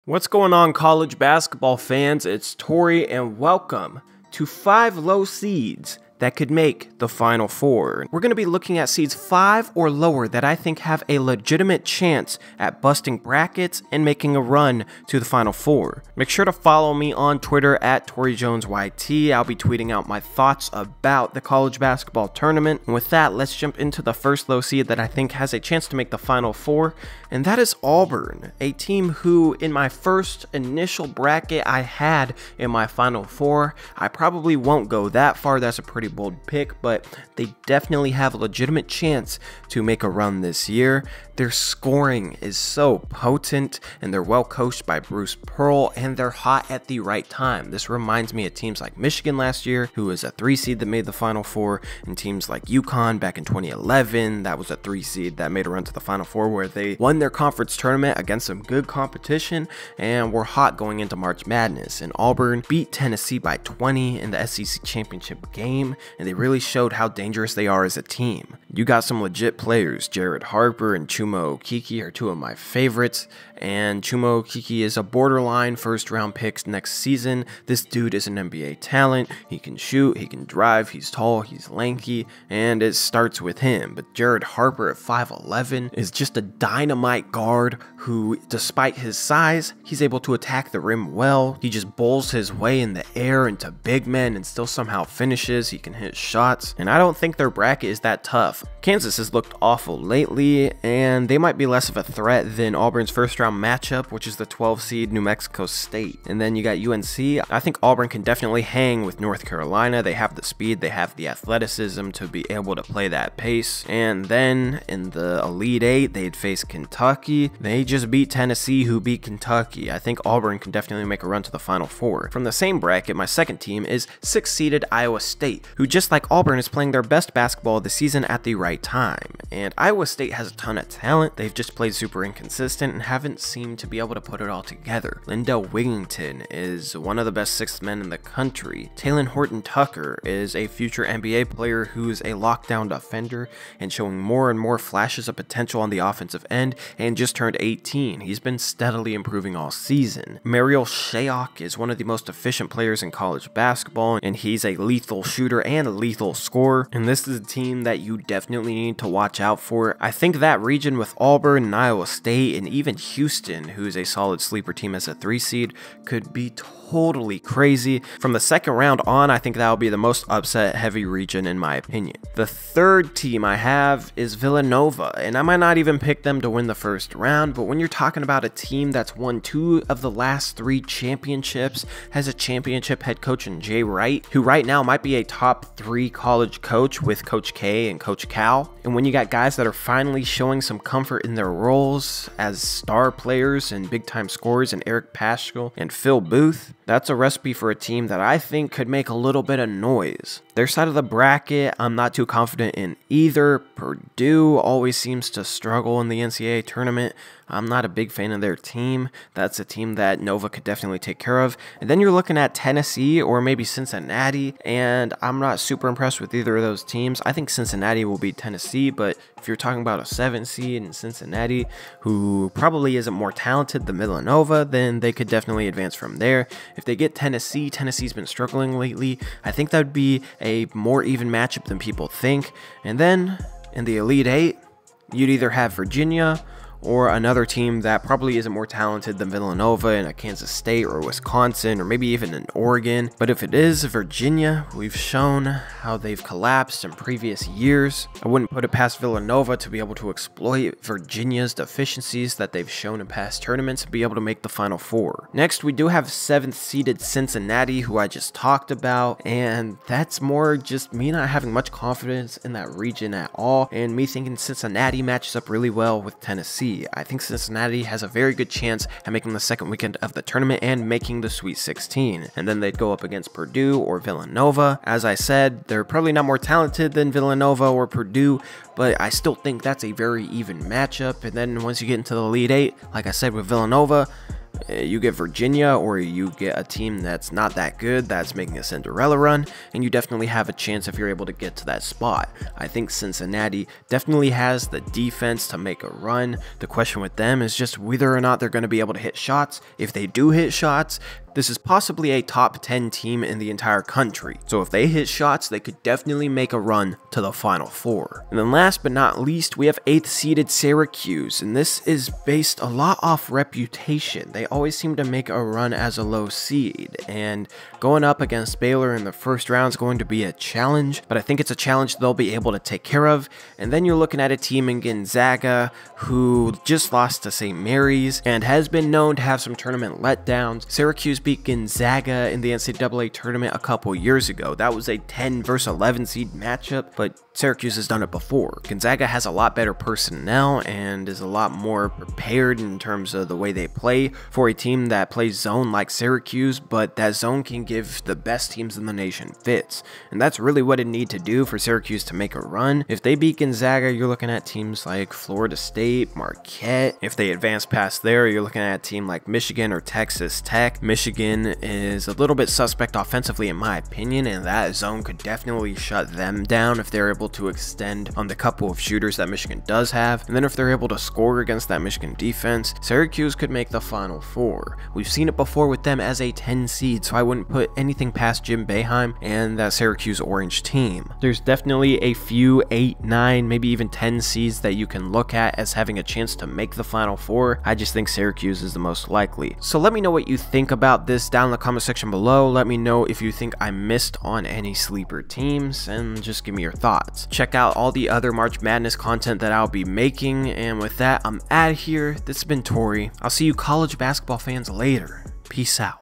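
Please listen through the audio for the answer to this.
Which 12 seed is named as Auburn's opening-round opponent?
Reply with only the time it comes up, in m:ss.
1:45.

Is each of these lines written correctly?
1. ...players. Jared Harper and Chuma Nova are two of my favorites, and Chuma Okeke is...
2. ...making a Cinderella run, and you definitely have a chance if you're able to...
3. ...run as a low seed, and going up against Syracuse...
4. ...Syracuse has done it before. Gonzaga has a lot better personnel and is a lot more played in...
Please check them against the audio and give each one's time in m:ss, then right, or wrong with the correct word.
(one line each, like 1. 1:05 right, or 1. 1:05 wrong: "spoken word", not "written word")
1. 1:09 wrong: "Okeke", not "Nova"
2. 4:48 right
3. 5:15 wrong: "Baylor", not "Syracuse"
4. 5:37 wrong: "prepared", not "played".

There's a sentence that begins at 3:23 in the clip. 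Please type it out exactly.
Purdue always seems to struggle in the NCAA tournament.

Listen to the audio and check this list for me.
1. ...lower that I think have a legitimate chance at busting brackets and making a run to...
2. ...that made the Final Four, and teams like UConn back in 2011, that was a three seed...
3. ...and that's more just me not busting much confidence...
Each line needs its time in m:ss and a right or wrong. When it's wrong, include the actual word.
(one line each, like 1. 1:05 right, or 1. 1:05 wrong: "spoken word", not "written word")
1. 0:09 right
2. 0:50 right
3. 4:19 wrong: "having", not "busting".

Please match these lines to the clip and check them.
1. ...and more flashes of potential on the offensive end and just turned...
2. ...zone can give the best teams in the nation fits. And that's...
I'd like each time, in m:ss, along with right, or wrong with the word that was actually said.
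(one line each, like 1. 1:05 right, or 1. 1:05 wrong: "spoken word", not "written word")
1. 2:24 right
2. 5:47 right.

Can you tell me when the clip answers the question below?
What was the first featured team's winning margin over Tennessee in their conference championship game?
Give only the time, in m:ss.
1:03.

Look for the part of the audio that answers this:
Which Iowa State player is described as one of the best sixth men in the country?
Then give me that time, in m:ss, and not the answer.
2:15.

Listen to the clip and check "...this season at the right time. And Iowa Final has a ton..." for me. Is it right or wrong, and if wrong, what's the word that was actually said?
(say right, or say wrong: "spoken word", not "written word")
wrong: "State", not "Final".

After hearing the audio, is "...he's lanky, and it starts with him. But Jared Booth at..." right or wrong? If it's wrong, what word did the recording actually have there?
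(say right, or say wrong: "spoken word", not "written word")
wrong: "Harper", not "Booth".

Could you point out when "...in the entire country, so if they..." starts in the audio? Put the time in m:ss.
5:03.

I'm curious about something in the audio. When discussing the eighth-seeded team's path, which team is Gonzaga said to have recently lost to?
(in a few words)
St. Mary's.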